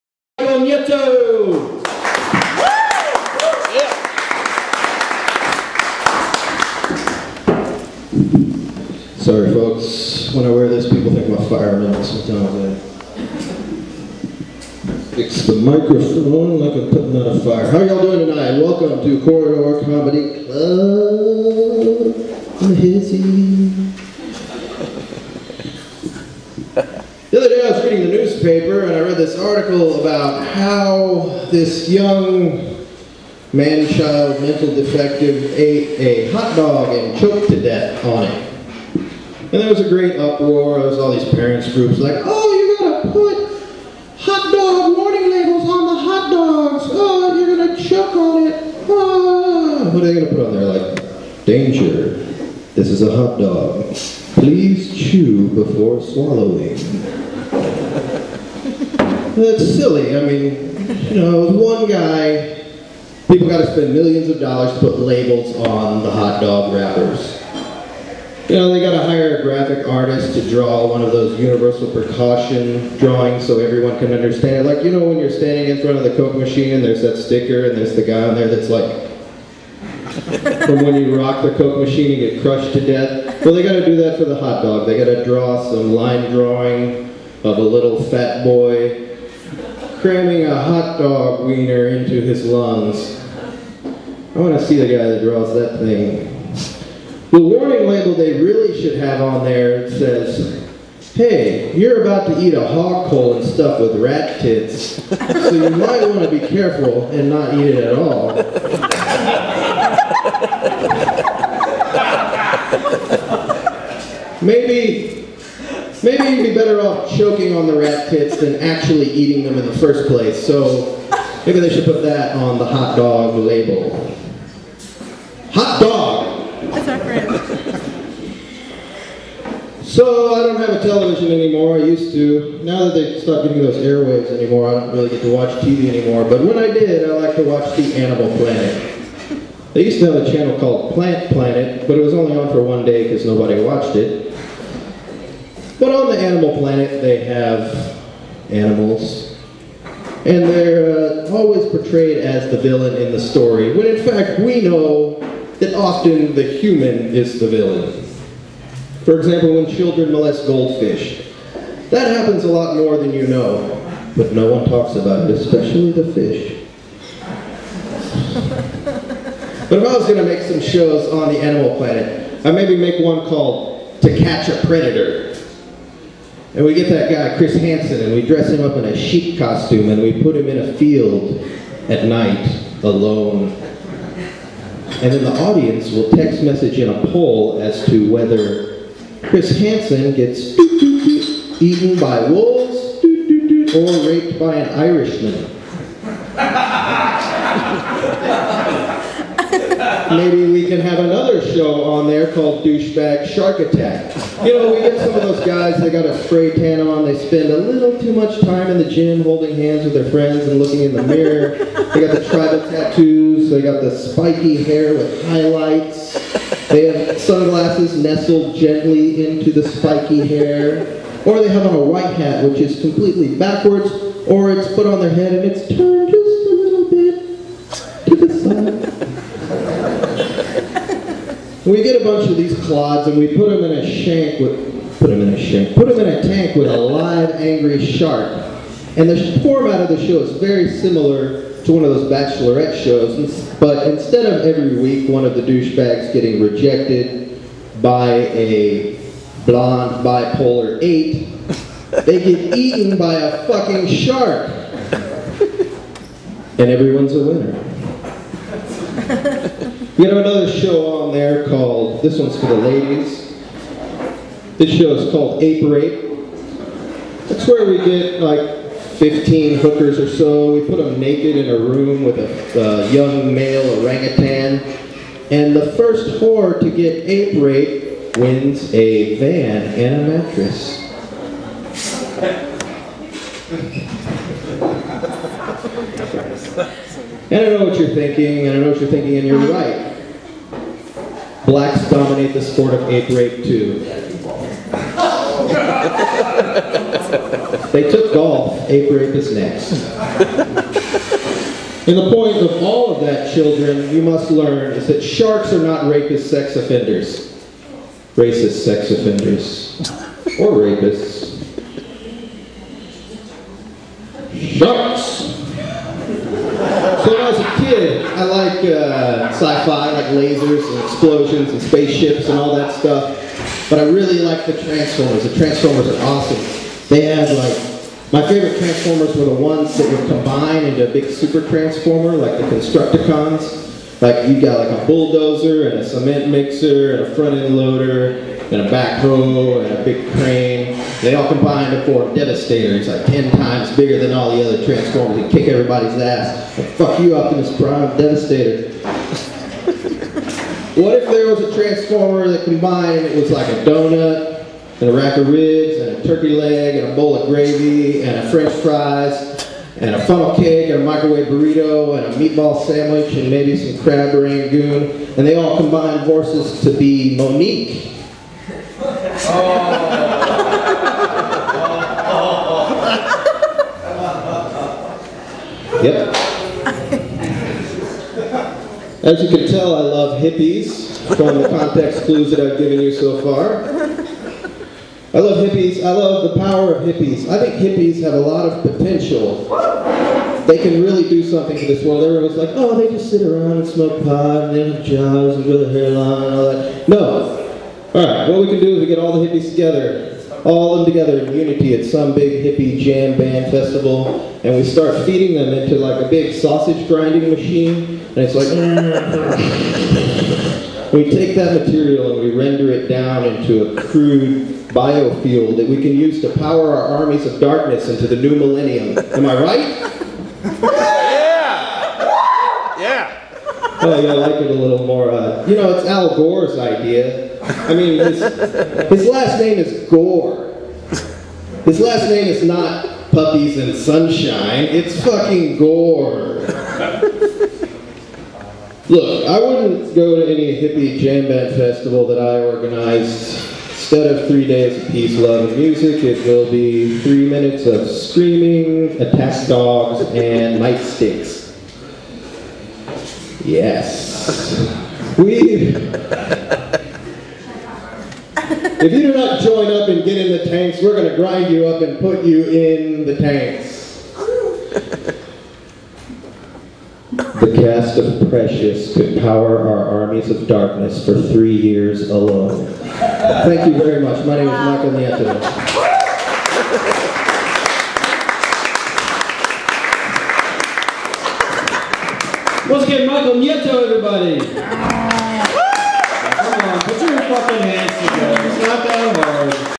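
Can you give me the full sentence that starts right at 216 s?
They have sunglasses nestled gently into the spiky hair.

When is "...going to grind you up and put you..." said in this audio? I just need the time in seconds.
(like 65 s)
460 s.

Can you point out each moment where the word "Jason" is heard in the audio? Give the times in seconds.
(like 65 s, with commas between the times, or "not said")
not said.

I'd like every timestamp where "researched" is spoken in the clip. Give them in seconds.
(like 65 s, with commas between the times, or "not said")
not said.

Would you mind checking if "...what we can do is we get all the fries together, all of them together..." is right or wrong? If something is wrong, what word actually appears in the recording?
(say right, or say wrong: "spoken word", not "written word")
wrong: "hippies", not "fries".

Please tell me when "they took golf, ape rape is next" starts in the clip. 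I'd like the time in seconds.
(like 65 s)
297 s.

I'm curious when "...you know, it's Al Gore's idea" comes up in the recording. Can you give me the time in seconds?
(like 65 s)
425 s.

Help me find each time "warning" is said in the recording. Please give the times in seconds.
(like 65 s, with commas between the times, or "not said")
44 s, 97 s.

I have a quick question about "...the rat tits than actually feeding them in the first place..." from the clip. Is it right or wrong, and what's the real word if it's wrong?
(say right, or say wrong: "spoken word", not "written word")
wrong: "eating", not "feeding".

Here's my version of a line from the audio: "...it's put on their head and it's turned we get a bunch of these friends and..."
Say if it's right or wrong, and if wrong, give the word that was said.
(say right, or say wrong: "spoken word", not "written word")
wrong: "clods", not "friends".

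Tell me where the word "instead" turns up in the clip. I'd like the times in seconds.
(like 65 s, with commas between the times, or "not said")
243 s, 443 s.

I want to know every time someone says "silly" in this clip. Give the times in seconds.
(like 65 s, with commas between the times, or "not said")
59 s.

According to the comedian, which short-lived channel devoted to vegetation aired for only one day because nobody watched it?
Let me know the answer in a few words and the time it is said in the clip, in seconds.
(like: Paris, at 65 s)
Plant Planet, at 140 s.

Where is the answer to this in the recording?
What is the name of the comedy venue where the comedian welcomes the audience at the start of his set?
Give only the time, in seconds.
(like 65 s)
19 s.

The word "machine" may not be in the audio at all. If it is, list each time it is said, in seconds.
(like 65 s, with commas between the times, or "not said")
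76 s, 81 s, 407 s.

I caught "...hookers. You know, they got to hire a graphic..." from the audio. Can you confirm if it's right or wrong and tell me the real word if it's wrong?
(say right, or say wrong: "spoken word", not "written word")
wrong: "wrappers", not "hookers".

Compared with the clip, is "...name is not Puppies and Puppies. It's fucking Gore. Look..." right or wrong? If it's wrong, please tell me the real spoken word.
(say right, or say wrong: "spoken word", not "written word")
wrong: "Sunshine", not "Puppies".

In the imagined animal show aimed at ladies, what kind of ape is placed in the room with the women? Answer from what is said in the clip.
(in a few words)
orangutan.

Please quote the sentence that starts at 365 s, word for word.
And they all combined forces to be Mo'Nique.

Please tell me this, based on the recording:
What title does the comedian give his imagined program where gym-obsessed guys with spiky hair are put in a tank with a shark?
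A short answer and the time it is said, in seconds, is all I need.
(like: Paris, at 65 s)
Douchebag Shark Attack, at 202 s.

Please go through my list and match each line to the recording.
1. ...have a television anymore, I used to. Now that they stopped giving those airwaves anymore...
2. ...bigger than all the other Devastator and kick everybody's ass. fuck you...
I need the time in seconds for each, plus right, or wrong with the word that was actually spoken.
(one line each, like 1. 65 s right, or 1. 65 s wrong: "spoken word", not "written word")
1. 130 s right
2. 343 s wrong: "Transformers", not "Devastator".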